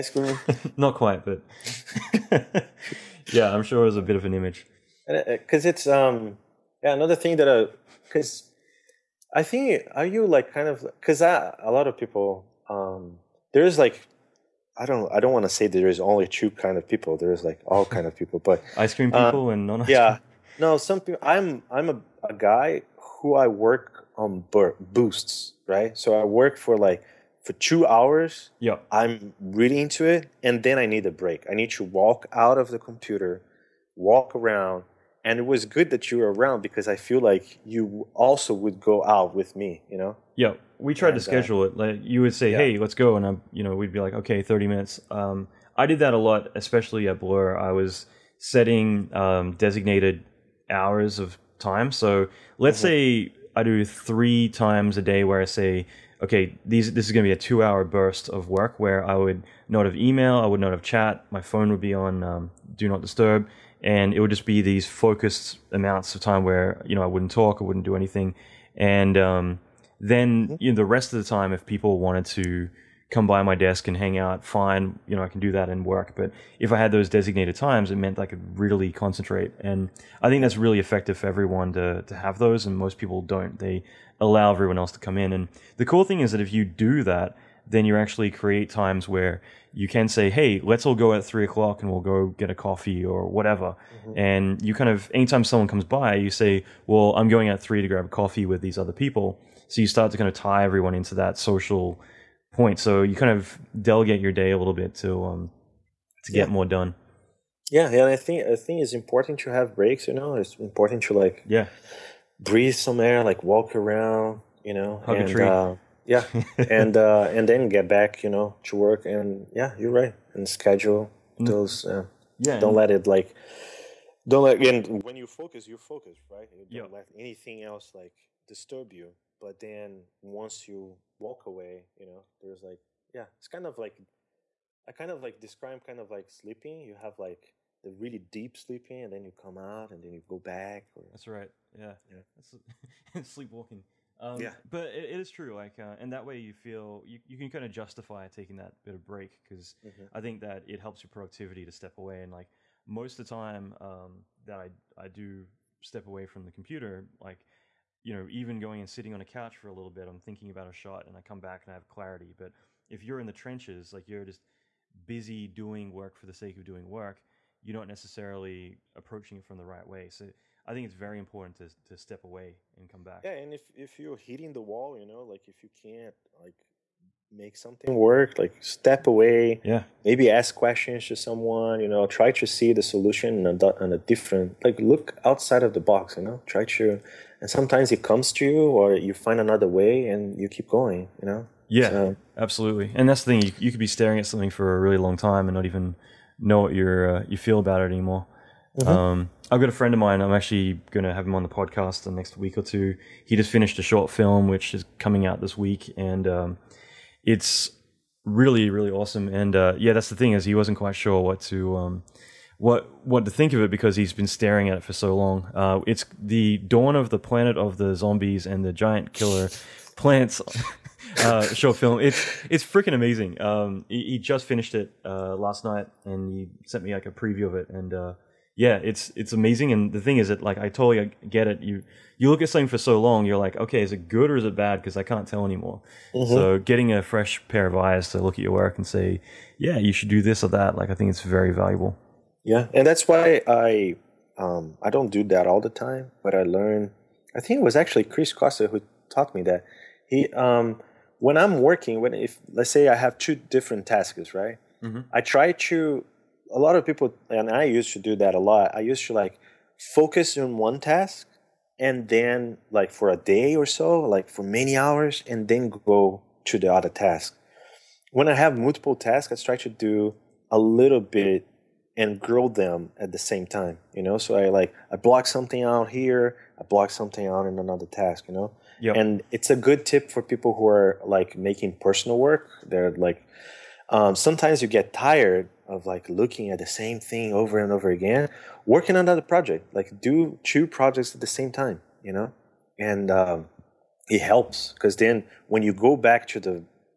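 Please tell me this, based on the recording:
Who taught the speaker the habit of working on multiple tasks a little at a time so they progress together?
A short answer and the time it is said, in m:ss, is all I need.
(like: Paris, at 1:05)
Chris Costa, at 4:08.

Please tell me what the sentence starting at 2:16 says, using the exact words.
You have like the really deep sleeping, and then you come out, and then you go back.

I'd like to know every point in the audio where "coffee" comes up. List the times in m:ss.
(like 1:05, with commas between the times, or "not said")
1:32, 1:38.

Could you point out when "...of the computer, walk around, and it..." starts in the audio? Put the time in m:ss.
0:32.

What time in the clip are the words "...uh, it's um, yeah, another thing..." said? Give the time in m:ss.
0:05.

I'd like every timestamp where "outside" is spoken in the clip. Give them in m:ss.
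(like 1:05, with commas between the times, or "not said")
3:05.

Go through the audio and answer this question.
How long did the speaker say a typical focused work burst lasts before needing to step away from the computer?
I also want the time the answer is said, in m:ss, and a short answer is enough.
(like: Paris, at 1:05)
2 hours, at 0:27.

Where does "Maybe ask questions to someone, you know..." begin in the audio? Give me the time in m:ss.
3:00.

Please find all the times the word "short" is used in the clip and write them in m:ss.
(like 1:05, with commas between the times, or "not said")
3:23, 3:41.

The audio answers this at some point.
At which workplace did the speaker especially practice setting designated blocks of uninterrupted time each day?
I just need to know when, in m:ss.
0:47.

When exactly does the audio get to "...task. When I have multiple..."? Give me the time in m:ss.
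4:26.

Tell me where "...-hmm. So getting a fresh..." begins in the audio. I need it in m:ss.
3:56.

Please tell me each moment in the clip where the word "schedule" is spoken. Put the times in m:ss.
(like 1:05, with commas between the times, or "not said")
0:41, 2:00.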